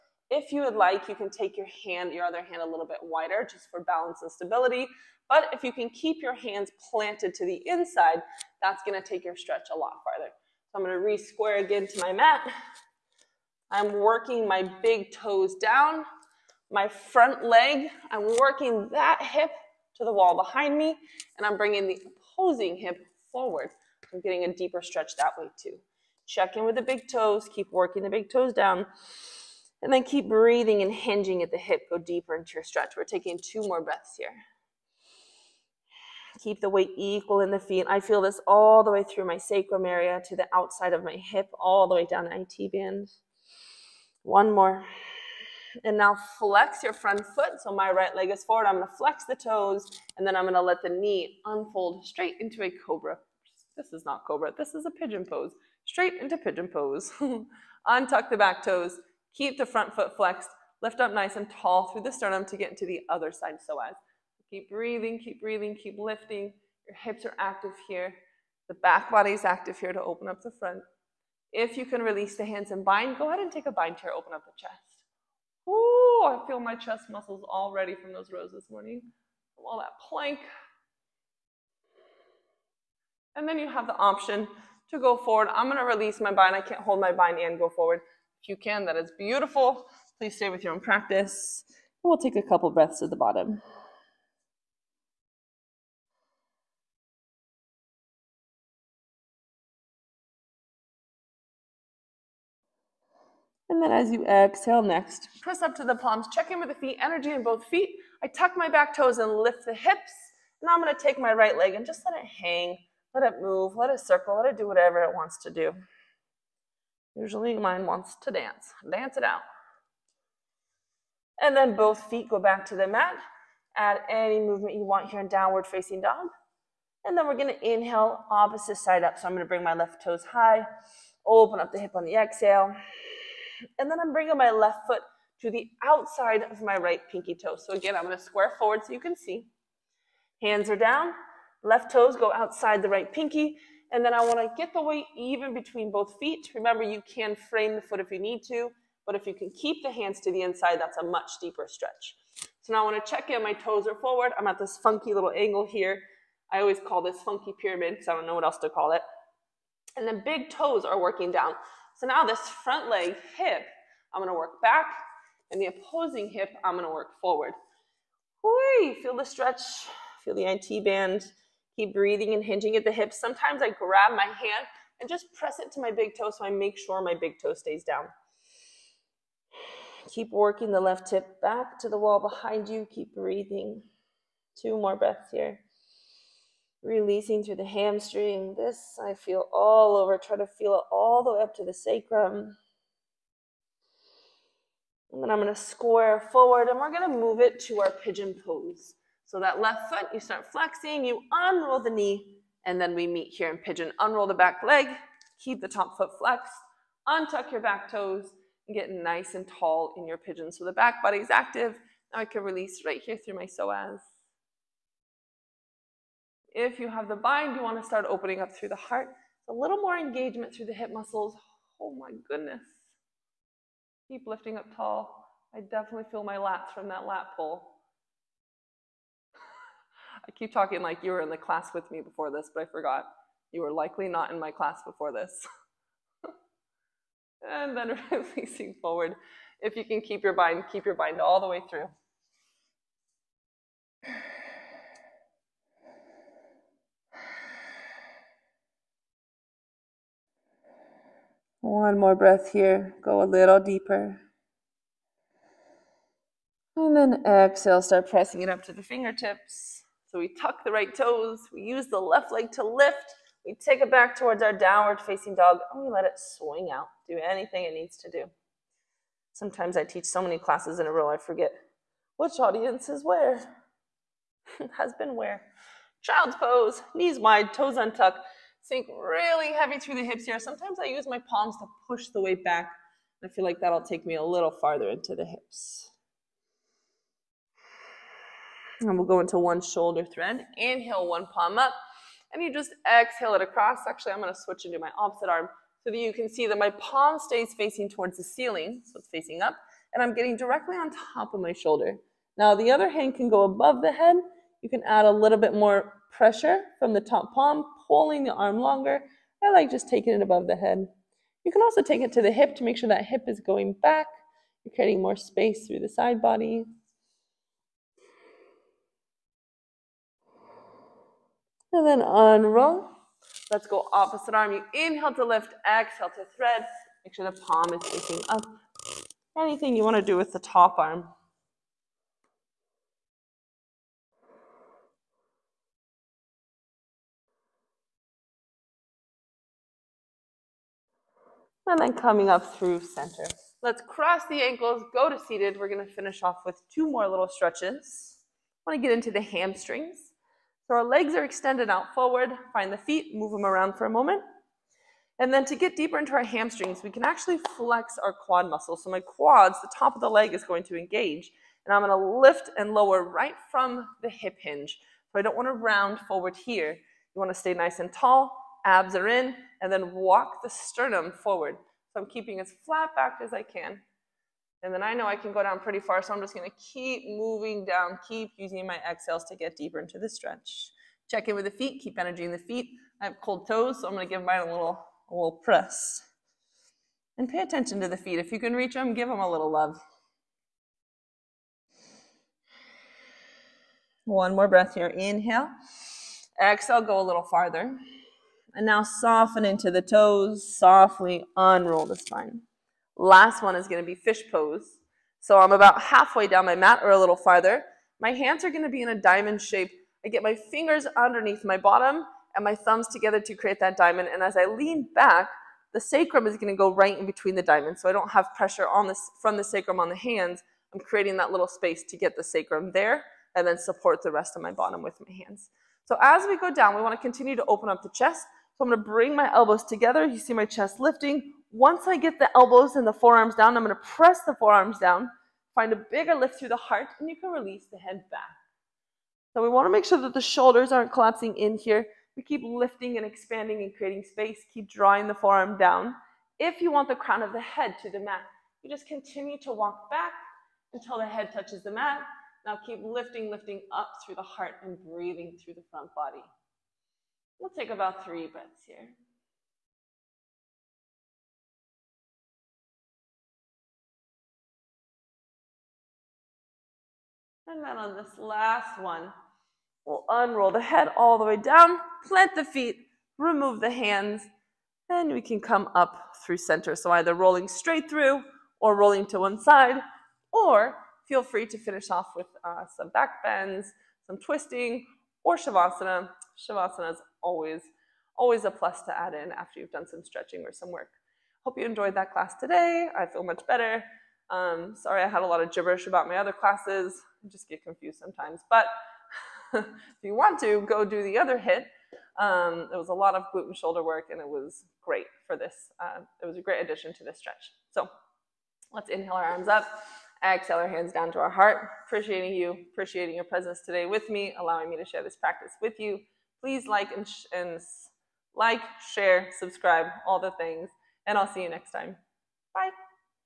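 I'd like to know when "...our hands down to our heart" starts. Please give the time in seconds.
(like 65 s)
510 s.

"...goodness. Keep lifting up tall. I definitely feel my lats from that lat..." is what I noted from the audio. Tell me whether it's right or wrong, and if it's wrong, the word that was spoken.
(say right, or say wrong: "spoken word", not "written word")
right.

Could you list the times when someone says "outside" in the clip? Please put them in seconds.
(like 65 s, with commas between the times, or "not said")
40 s, 135 s, 142 s.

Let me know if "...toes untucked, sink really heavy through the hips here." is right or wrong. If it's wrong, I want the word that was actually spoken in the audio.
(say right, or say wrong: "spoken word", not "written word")
right.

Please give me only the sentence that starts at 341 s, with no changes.
And then coming up through center.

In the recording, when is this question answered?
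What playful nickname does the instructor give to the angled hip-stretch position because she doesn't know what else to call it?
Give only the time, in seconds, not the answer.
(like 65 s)
157 s.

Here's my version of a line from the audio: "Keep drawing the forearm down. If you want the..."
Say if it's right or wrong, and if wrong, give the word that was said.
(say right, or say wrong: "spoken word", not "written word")
right.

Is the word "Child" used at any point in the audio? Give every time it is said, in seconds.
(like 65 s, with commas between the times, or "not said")
276 s.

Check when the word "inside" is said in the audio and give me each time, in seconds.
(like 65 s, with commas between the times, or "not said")
7 s, 150 s.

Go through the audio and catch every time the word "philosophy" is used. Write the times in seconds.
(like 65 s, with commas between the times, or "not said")
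not said.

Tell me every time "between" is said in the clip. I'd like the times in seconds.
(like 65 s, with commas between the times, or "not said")
145 s, 417 s.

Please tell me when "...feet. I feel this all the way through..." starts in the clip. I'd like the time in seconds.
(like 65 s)
37 s.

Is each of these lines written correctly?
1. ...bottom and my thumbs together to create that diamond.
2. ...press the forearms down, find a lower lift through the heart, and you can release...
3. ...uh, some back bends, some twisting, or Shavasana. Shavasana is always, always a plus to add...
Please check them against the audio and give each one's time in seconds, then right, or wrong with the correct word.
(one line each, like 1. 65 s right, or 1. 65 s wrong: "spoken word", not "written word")
1. 411 s right
2. 433 s wrong: "bigger", not "lower"
3. 482 s right.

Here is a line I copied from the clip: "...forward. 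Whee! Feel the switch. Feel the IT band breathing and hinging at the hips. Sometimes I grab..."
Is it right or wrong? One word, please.
wrong.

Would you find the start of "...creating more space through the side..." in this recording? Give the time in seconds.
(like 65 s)
314 s.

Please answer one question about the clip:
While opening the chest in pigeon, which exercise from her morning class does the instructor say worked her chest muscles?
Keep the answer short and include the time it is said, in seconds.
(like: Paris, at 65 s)
Rows, at 78 s.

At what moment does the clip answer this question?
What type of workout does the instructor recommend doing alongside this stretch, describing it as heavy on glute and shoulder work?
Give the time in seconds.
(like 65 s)
501 s.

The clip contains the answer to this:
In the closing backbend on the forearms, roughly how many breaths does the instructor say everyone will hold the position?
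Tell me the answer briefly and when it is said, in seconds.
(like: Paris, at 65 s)
3, at 458 s.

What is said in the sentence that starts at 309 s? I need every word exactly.
I like just taking it above the head.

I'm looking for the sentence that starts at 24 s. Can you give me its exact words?
I'm getting a deeper stretch that way too.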